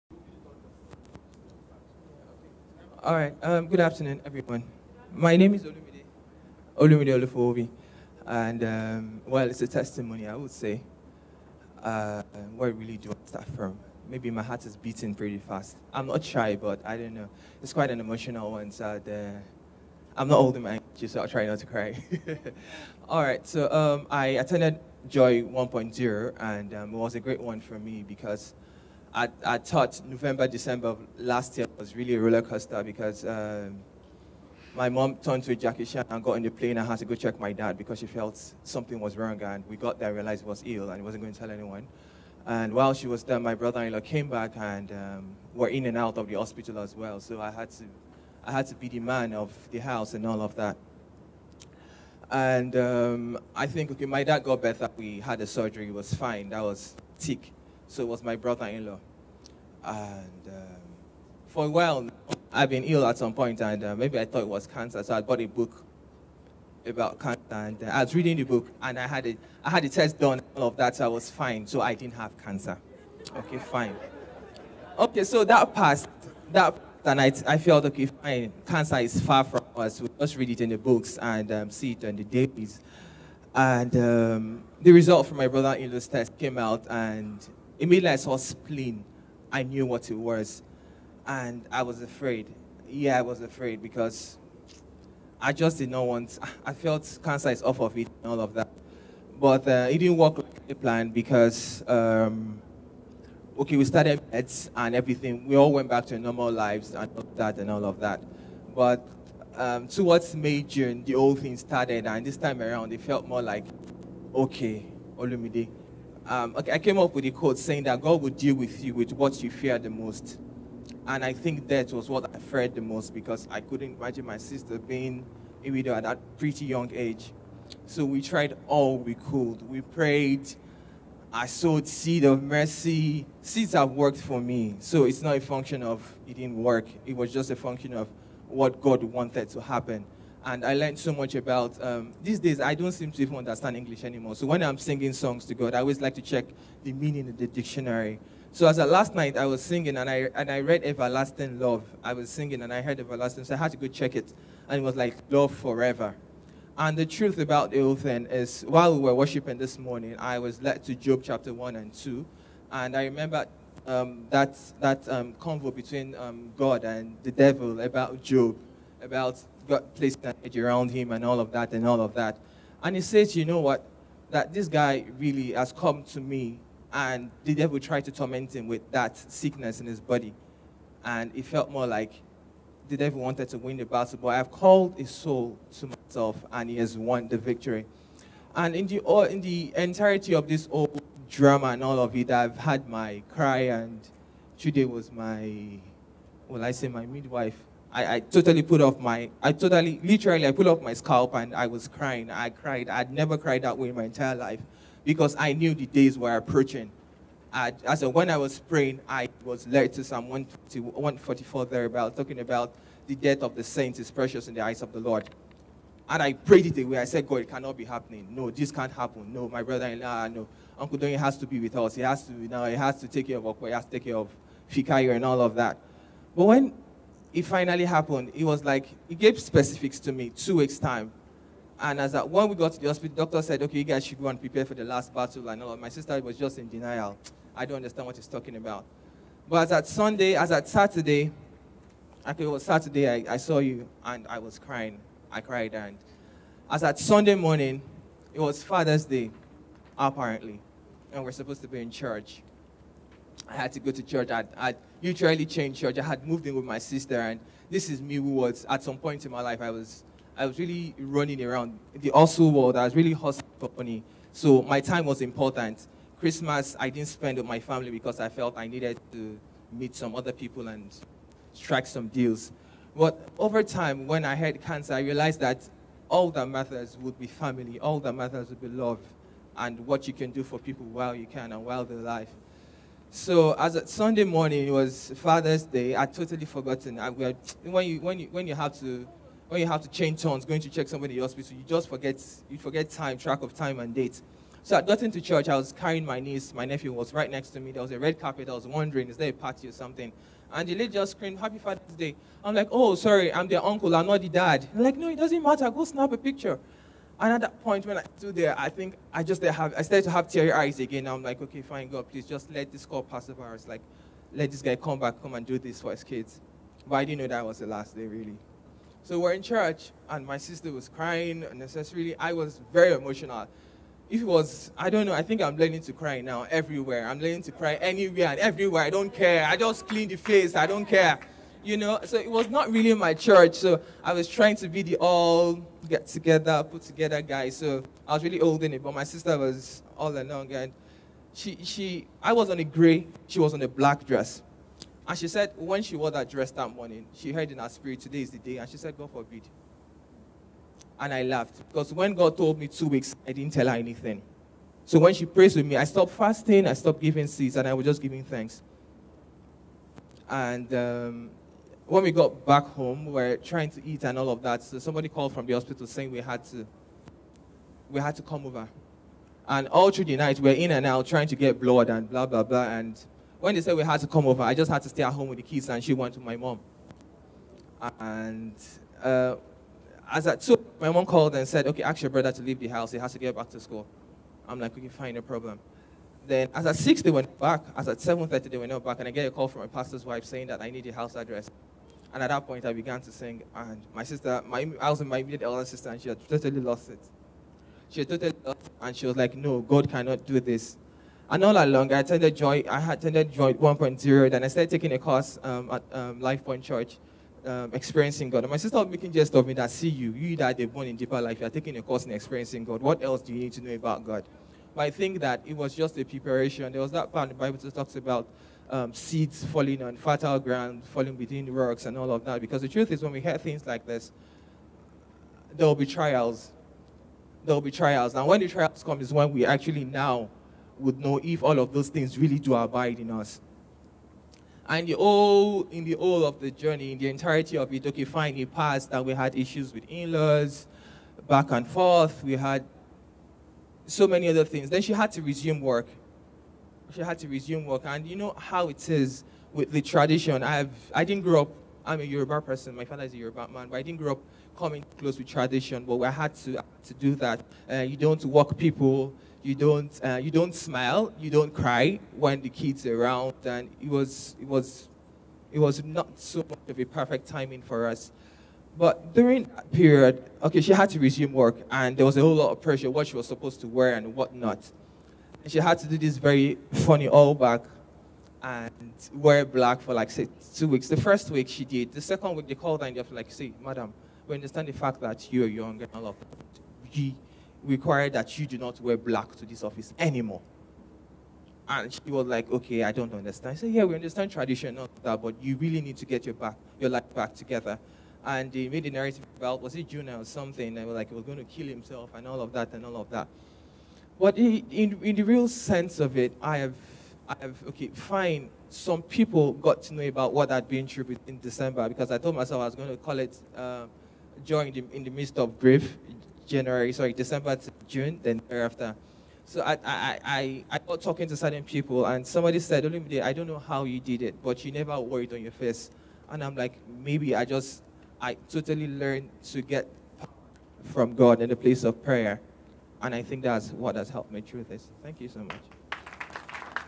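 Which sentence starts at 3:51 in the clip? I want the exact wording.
And as that, when we got to the hospital, doctor said, okay, you guys should go and prepare for the last battle.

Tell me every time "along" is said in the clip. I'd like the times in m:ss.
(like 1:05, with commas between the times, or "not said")
5:40, 6:41.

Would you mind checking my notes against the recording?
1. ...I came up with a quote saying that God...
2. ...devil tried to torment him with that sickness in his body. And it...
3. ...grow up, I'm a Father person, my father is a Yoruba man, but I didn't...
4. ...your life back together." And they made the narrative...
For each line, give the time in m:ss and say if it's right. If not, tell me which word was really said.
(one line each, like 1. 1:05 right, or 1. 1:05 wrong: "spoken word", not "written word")
1. 1:56 right
2. 2:57 right
3. 7:31 wrong: "Yoruba", not "Father"
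4. 8:16 right.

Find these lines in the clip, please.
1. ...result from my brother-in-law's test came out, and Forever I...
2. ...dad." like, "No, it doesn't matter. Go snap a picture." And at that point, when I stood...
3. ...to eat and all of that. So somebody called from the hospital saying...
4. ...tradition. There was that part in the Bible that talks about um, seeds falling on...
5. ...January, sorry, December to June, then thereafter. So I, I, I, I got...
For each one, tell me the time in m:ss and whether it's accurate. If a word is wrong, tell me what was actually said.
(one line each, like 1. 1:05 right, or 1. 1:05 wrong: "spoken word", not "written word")
1. 1:24 wrong: "Immediately", not "Forever"
2. 5:04 right
3. 6:03 right
4. 6:56 wrong: "preparation", not "tradition"
5. 8:36 right.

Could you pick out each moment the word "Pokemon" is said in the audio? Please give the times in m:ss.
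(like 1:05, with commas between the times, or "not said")
not said.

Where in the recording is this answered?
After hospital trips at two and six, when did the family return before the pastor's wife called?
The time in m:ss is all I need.
6:27.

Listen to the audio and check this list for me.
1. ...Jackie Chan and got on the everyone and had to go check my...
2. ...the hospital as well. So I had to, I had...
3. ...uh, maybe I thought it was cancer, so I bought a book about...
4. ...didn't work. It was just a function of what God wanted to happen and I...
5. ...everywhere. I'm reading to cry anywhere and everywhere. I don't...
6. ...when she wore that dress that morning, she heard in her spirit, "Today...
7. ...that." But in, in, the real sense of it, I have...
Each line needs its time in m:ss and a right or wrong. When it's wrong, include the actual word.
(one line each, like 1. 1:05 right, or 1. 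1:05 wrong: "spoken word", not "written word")
1. 0:35 wrong: "plane", not "everyone"
2. 0:46 right
3. 1:03 right
4. 2:16 right
5. 5:26 wrong: "learning", not "reading"
6. 5:45 right
7. 8:23 right.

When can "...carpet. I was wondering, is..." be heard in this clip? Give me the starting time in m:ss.
4:58.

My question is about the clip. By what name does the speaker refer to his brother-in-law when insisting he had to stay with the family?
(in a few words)
Uncle Donny.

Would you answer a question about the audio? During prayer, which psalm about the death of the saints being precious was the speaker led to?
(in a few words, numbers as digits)
Psalm 144.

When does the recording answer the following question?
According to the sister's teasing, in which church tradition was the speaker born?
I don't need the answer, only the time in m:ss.
6:50.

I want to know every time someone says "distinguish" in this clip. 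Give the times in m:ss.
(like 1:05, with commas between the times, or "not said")
not said.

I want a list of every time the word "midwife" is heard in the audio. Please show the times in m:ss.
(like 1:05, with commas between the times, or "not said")
3:17.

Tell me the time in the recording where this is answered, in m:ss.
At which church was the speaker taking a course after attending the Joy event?
6:46.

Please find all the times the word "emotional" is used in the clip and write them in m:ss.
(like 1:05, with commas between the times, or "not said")
0:17, 5:22.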